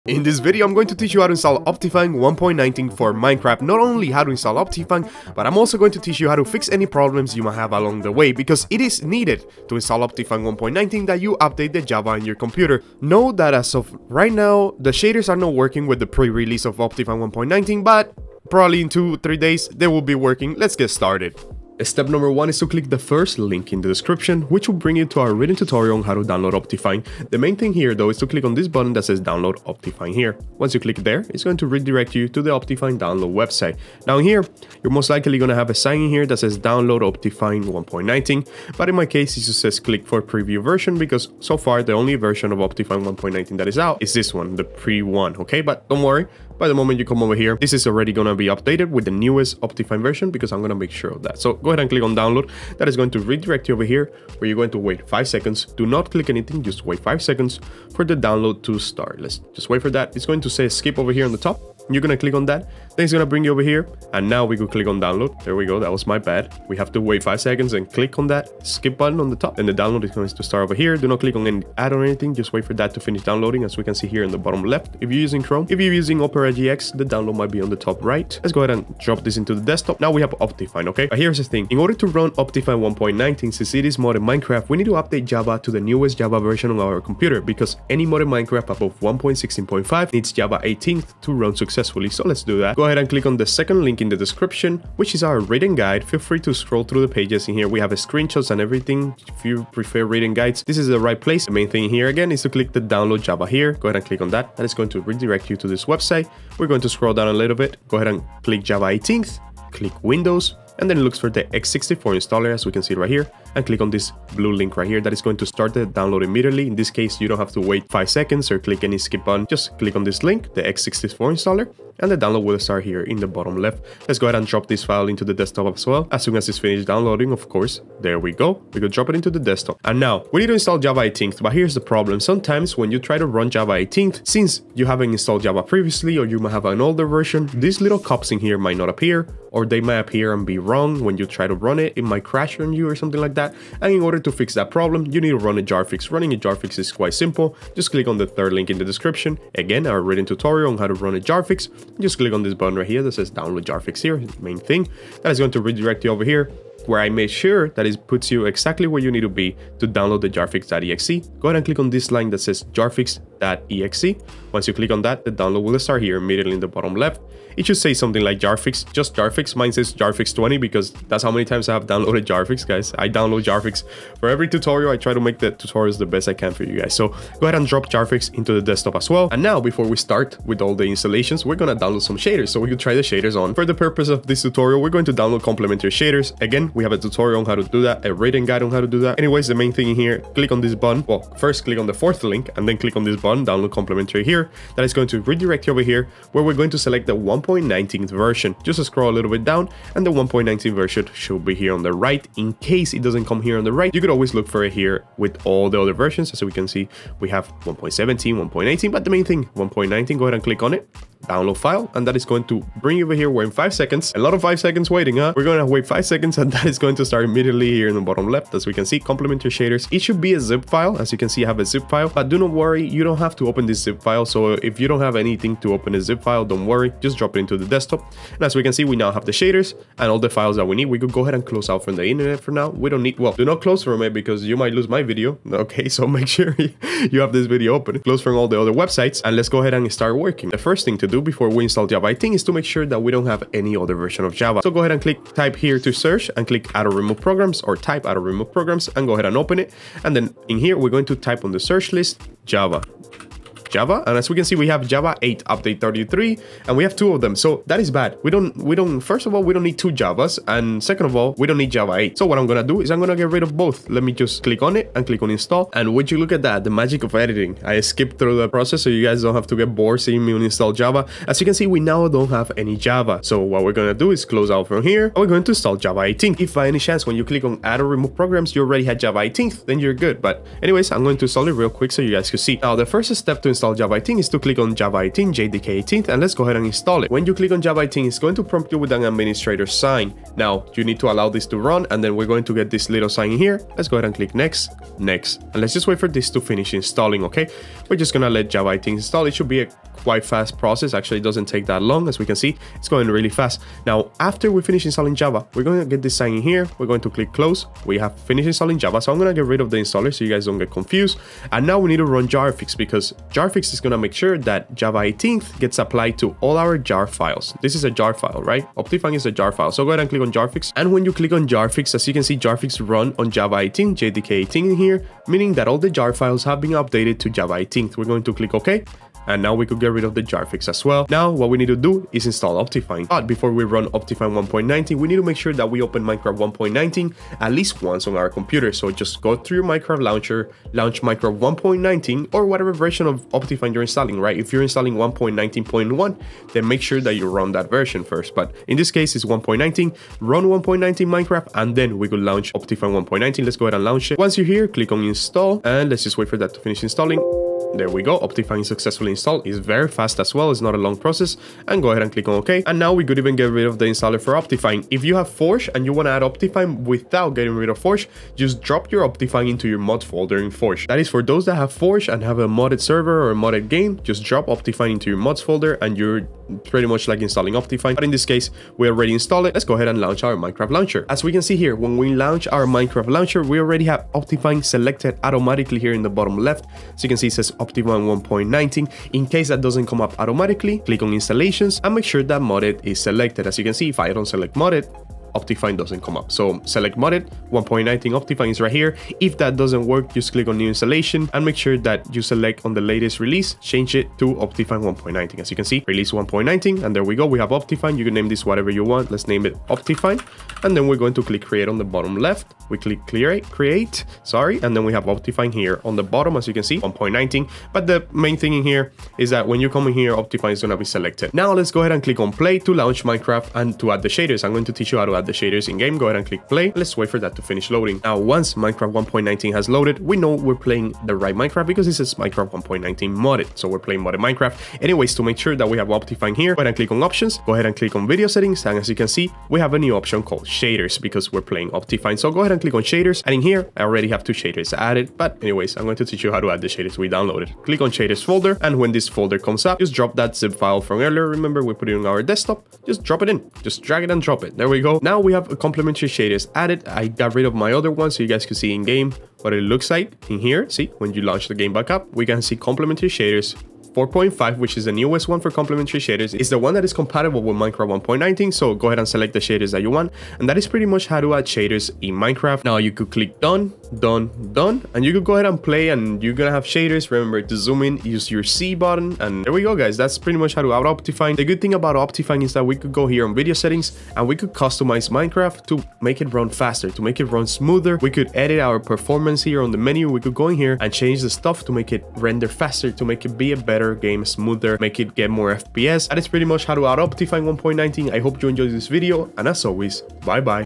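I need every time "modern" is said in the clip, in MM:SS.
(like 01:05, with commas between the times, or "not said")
01:23, 01:28.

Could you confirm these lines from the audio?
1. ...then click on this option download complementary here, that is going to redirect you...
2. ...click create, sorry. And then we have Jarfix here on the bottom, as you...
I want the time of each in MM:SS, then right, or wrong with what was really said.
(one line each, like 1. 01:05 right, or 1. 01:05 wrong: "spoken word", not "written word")
1. 03:12 wrong: "button", not "option"
2. 06:52 wrong: "Optifine", not "Jarfix".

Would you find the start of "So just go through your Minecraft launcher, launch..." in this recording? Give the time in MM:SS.
05:38.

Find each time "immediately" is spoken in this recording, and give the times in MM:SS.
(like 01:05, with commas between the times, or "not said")
01:56, 02:46, 03:37.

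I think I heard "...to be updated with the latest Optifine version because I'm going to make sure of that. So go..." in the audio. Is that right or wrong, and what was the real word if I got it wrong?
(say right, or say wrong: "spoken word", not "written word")
wrong: "newest", not "latest".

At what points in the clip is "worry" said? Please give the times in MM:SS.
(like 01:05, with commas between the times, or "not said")
00:46, 03:42, 03:46.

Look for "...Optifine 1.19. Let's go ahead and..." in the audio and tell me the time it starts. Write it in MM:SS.
05:52.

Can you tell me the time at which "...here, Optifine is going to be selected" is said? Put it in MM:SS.
06:59.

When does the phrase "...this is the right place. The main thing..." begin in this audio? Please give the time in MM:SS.
01:40.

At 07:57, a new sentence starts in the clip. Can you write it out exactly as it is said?
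Remember to zoom in, use your C button.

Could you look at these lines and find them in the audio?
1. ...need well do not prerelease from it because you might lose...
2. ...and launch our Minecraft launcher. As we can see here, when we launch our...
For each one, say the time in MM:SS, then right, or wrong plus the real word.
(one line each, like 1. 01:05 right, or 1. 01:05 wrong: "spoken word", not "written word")
1. 03:53 wrong: "close", not "prerelease"
2. 06:19 right.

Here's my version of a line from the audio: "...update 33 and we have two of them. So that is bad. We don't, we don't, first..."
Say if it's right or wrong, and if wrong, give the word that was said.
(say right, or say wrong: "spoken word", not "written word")
right.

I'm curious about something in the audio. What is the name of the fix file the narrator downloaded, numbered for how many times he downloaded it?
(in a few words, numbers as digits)
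Jarfix20.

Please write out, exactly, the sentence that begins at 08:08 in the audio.
We could edit our performance here on the menu.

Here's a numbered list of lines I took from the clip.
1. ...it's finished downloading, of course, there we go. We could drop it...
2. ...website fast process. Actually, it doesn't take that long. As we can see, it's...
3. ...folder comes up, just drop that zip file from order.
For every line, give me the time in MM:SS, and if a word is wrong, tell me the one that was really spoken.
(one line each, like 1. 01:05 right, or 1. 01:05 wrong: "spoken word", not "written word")
1. 02:06 right
2. 05:00 wrong: "quite", not "website"
3. 07:29 wrong: "earlier", not "order".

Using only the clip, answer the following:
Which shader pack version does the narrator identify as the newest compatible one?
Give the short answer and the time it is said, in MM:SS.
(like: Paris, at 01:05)
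4.5, at 07:43.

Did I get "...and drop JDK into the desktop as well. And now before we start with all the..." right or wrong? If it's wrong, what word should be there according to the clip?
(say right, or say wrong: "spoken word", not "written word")
wrong: "Jarfix", not "JDK".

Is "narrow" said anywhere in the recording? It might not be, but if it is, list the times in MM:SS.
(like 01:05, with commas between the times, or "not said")
not said.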